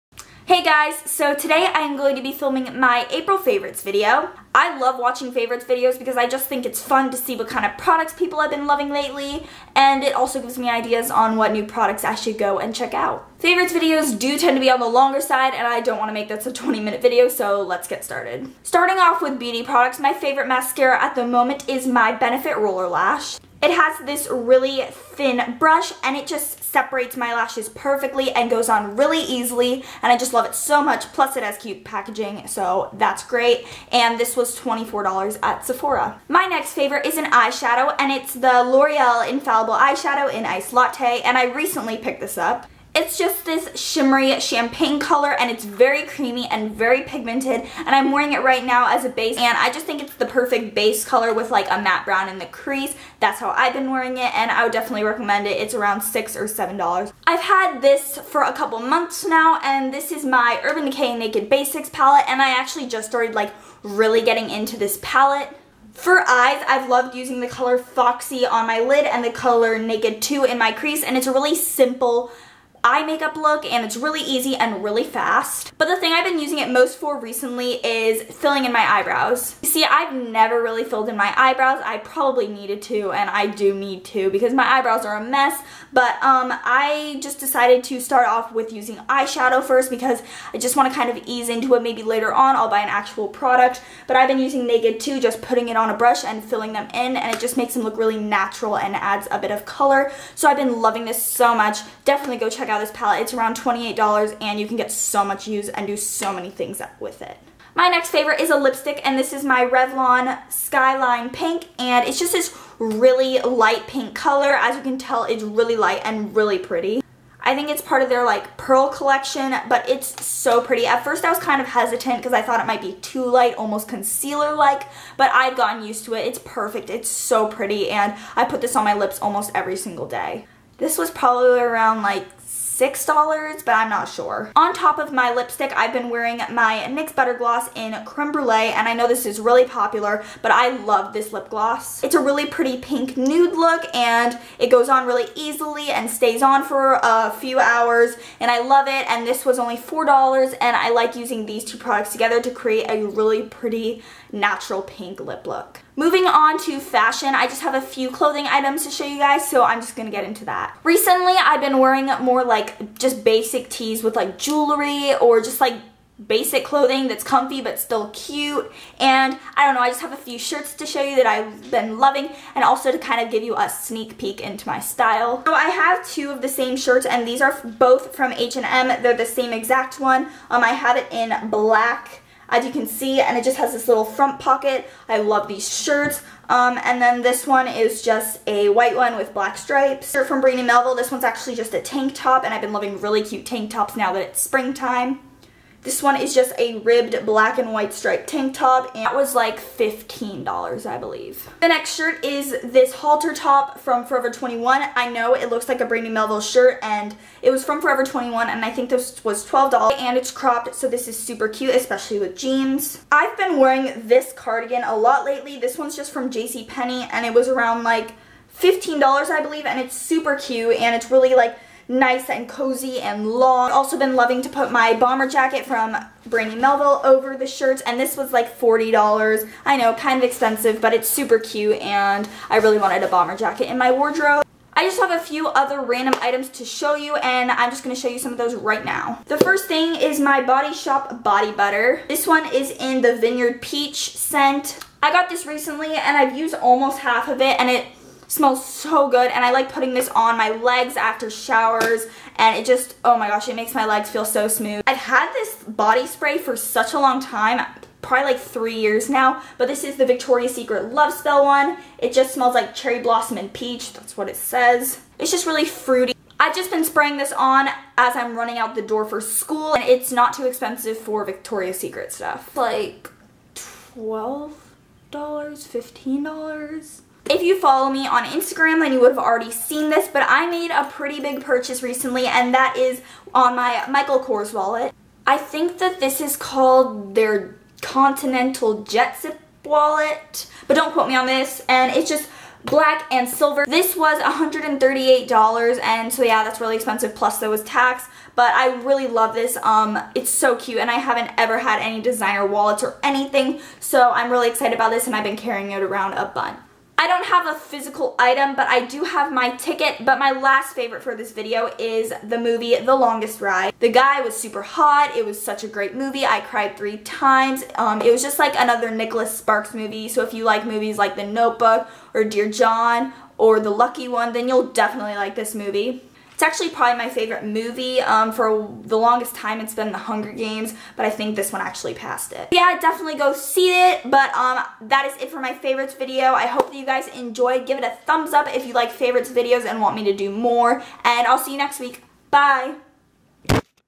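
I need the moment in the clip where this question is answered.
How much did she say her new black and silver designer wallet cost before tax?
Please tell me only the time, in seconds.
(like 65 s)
294 s.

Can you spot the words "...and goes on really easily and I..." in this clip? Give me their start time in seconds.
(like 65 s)
28 s.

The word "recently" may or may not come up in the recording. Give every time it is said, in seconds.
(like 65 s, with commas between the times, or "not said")
41 s, 77 s, 160 s, 245 s, 281 s.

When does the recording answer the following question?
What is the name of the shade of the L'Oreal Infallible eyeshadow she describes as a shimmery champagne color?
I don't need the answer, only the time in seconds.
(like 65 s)
40 s.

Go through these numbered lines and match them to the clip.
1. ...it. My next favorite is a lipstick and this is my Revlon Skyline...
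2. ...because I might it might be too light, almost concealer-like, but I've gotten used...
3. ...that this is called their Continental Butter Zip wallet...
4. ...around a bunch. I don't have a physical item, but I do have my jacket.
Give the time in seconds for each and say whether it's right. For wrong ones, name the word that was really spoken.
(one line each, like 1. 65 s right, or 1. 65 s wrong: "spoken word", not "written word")
1. 107 s right
2. 122 s wrong: "thought", not "might"
3. 285 s wrong: "Jet", not "Butter"
4. 305 s wrong: "ticket", not "jacket".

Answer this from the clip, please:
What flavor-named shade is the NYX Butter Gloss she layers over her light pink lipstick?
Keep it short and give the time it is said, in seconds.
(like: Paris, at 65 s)
Creme Brulee, at 138 s.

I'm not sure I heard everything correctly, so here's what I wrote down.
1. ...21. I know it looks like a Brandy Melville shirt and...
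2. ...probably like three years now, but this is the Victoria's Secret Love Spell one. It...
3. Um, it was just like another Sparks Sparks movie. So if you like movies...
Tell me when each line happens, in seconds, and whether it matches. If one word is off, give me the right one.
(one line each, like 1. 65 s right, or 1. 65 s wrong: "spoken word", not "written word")
1. 204 s right
2. 258 s right
3. 317 s wrong: "Nicholas", not "Sparks".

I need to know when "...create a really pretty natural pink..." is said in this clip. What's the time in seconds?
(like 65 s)
152 s.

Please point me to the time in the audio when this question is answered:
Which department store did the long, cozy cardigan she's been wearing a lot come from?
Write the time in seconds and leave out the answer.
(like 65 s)
216 s.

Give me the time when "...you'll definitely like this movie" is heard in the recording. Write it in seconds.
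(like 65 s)
324 s.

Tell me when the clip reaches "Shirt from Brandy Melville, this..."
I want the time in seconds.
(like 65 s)
190 s.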